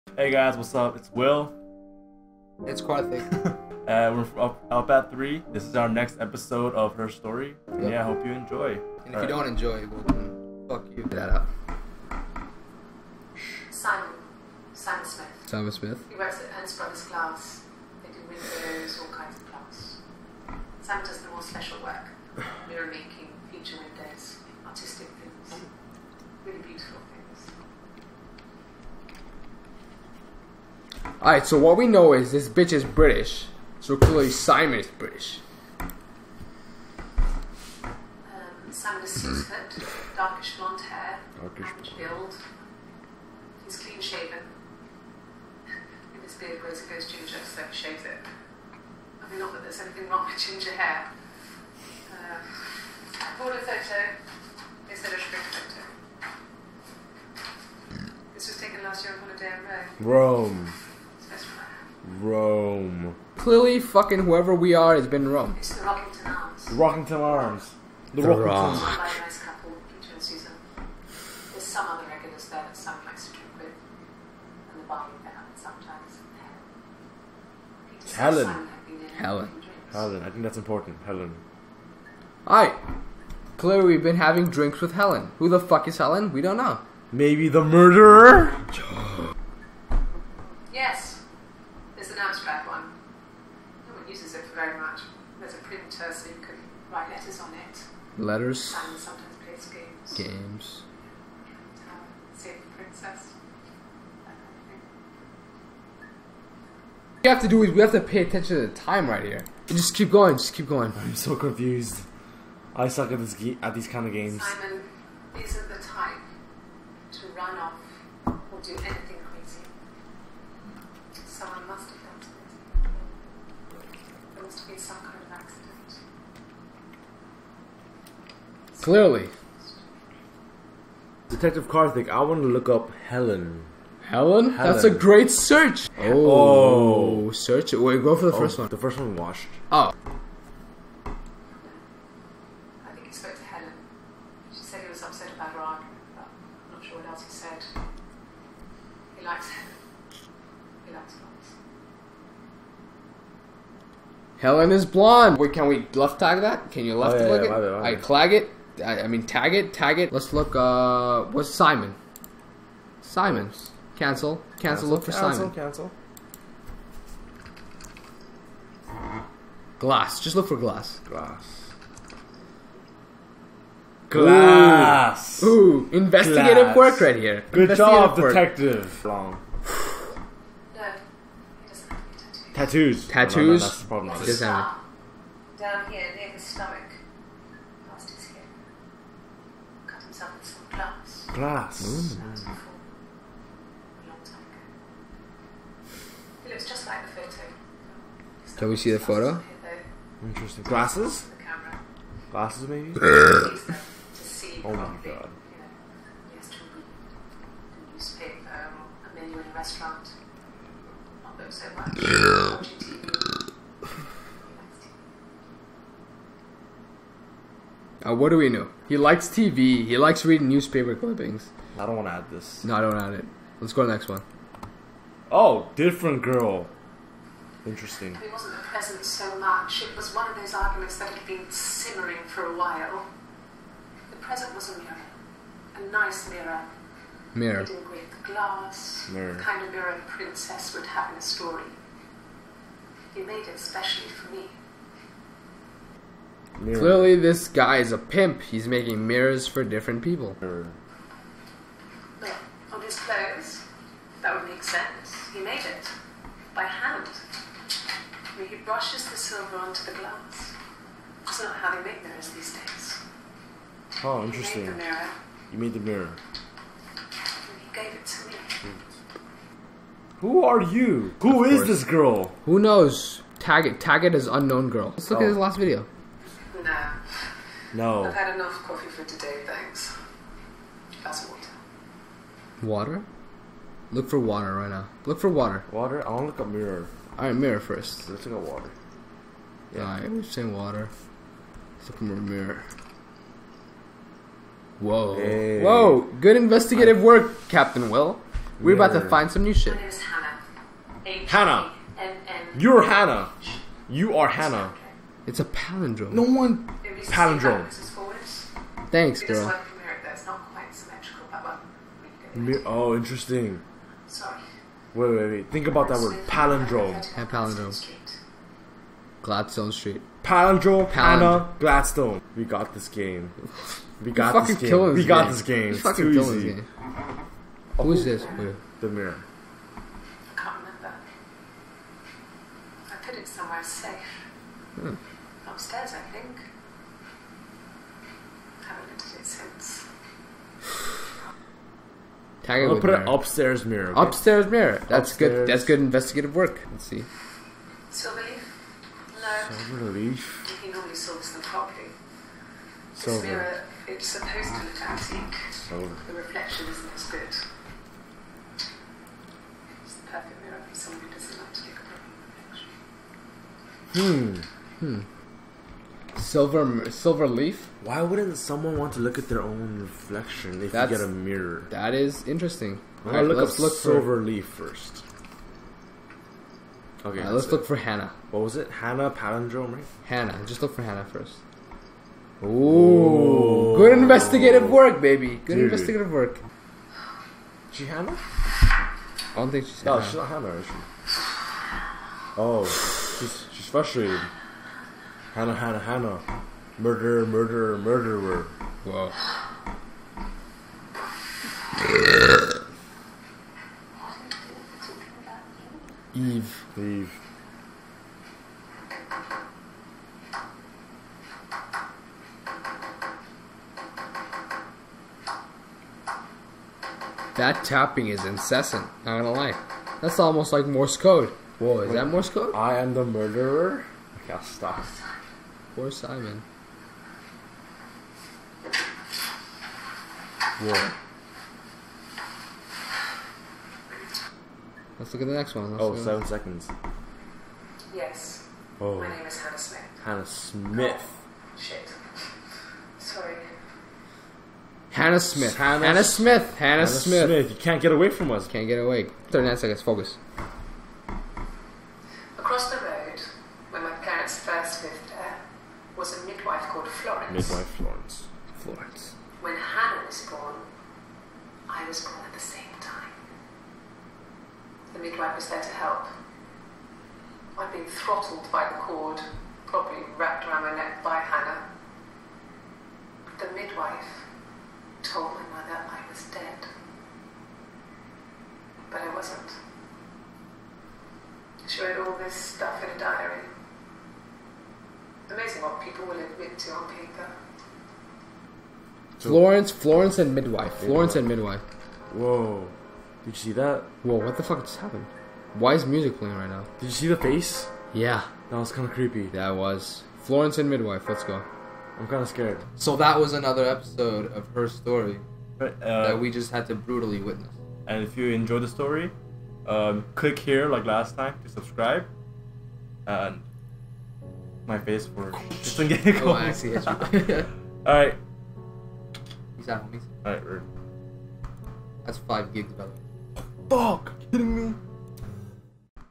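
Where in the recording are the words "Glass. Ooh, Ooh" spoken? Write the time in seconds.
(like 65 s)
174 s.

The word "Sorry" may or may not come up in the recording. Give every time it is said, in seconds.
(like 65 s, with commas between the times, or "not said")
314 s, 443 s.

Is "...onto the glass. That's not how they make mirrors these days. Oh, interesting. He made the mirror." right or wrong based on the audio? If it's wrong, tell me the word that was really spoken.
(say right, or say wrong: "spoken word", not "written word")
right.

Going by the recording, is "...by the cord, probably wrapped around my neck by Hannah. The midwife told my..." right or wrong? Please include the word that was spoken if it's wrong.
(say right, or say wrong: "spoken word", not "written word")
right.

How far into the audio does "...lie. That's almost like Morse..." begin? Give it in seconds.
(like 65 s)
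419 s.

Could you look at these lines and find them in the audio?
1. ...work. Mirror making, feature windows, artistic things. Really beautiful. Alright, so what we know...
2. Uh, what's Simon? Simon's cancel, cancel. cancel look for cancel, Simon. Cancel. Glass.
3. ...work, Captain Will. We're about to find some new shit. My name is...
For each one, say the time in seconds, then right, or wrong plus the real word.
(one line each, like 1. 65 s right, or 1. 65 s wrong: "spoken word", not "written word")
1. 21 s right
2. 160 s right
3. 297 s right.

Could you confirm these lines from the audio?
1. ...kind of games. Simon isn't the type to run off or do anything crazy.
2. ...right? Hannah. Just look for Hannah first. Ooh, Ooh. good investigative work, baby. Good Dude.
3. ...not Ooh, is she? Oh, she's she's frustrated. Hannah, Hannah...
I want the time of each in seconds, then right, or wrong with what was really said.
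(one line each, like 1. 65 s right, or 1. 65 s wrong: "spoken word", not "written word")
1. 113 s right
2. 379 s right
3. 390 s wrong: "Hannah", not "Ooh".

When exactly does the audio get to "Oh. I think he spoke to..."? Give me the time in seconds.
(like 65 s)
139 s.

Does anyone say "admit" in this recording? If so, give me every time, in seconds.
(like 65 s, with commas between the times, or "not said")
486 s.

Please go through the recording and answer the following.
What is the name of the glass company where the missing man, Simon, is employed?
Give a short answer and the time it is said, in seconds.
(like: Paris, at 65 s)
Ernst Brothers Glass, at 16 s.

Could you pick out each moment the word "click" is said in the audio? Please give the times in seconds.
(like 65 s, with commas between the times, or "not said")
157 s, 510 s.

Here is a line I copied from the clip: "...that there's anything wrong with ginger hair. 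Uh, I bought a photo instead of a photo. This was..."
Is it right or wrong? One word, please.
right.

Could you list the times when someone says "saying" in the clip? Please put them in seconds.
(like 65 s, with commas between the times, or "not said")
290 s.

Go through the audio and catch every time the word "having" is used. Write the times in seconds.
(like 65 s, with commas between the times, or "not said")
84 s.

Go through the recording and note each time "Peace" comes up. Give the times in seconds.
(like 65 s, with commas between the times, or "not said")
519 s.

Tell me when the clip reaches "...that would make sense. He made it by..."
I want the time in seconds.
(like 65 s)
254 s.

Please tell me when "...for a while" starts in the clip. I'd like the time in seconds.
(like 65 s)
232 s.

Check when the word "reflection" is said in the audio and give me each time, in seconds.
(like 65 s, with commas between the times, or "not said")
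356 s, 364 s, 369 s.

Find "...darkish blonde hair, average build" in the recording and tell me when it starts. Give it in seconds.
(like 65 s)
40 s.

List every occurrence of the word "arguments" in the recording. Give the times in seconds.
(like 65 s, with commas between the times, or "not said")
230 s.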